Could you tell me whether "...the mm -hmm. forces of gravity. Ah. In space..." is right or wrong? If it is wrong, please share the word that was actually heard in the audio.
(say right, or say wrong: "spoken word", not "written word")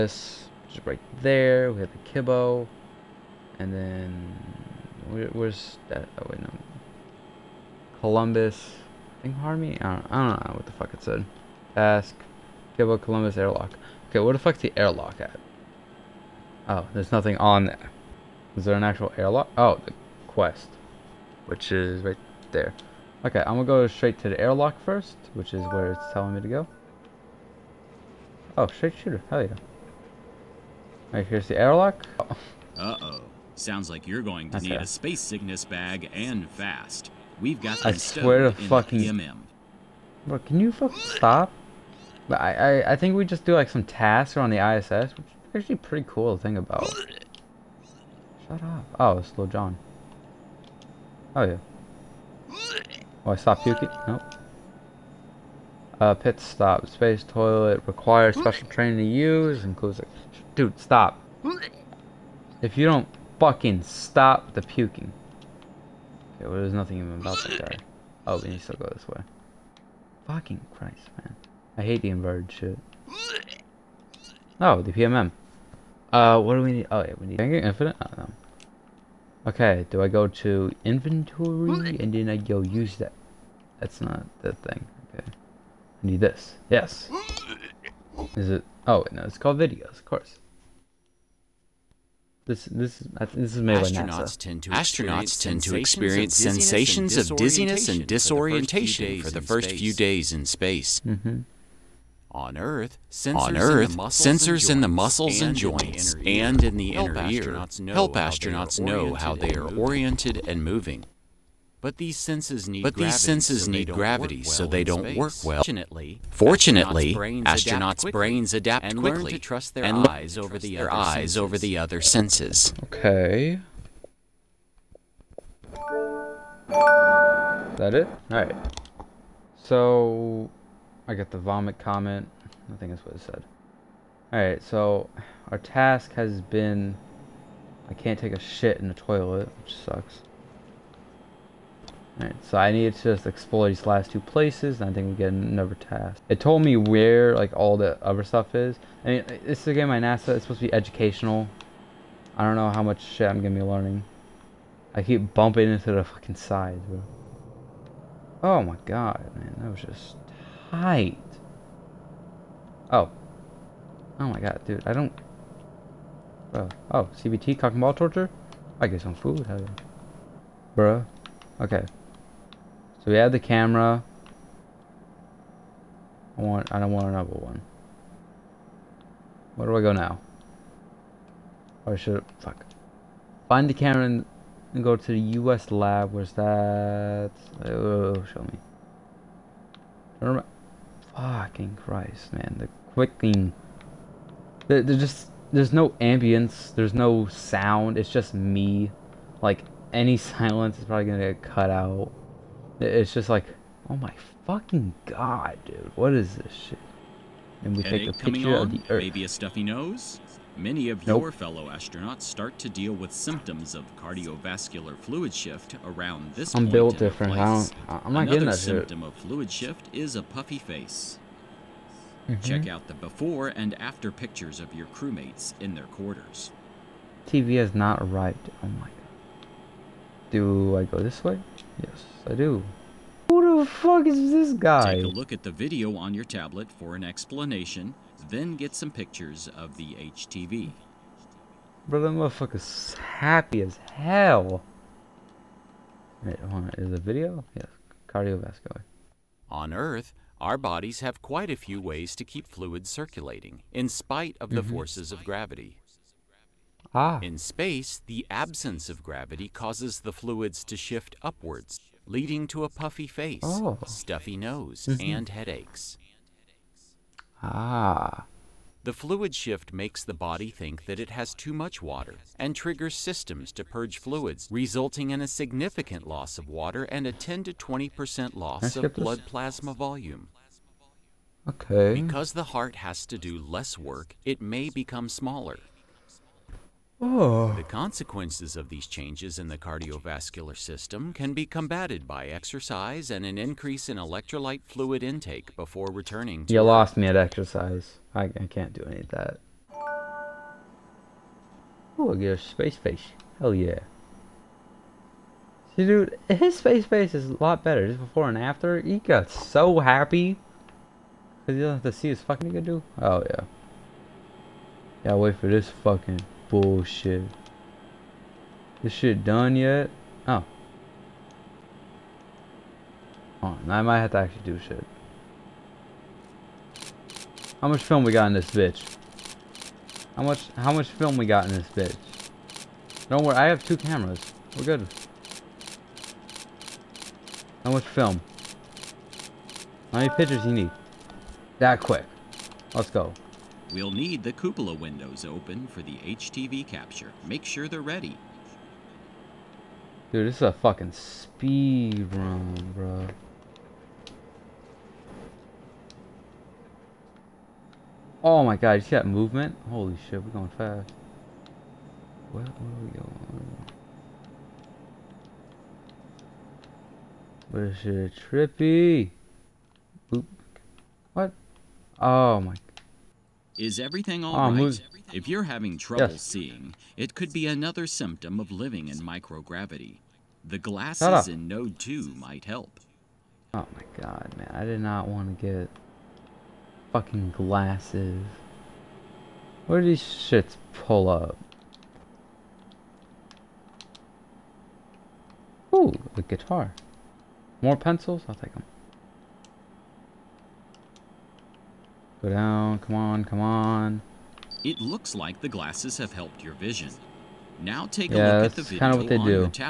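right.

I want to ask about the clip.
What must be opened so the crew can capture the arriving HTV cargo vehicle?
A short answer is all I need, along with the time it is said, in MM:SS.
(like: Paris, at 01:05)
The cupola windows, at 05:44.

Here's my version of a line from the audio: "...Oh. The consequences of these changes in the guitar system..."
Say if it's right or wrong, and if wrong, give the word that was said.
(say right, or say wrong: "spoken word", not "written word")
wrong: "cardiovascular", not "guitar".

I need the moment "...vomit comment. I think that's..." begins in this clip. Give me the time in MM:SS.
02:11.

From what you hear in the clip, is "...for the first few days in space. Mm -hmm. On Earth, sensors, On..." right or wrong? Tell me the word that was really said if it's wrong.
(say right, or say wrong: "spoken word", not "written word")
right.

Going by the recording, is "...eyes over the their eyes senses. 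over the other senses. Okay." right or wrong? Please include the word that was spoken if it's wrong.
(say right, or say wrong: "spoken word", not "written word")
right.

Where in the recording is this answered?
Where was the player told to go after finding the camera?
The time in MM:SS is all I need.
03:05.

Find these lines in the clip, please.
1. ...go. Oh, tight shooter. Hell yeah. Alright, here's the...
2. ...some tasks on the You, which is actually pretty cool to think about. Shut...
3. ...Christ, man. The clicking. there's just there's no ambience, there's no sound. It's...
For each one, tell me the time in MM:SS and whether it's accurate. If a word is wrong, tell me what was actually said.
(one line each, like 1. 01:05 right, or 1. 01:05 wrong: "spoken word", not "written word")
1. 00:26 wrong: "straight", not "tight"
2. 00:43 wrong: "ISS", not "You"
3. 03:11 right.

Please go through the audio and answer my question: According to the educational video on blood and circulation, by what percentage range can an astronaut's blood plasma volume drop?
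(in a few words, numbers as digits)
10 to 20%.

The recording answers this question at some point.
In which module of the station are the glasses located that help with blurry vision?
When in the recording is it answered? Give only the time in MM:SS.
06:21.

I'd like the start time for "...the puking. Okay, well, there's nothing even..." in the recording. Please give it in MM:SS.
01:04.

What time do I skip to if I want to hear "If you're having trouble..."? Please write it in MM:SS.
06:15.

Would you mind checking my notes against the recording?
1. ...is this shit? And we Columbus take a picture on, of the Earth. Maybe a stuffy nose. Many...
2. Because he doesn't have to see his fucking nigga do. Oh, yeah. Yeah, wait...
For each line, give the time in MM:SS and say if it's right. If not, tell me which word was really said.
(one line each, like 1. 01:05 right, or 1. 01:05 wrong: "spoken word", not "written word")
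1. 03:26 wrong: "Headache", not "Columbus"
2. 05:11 right.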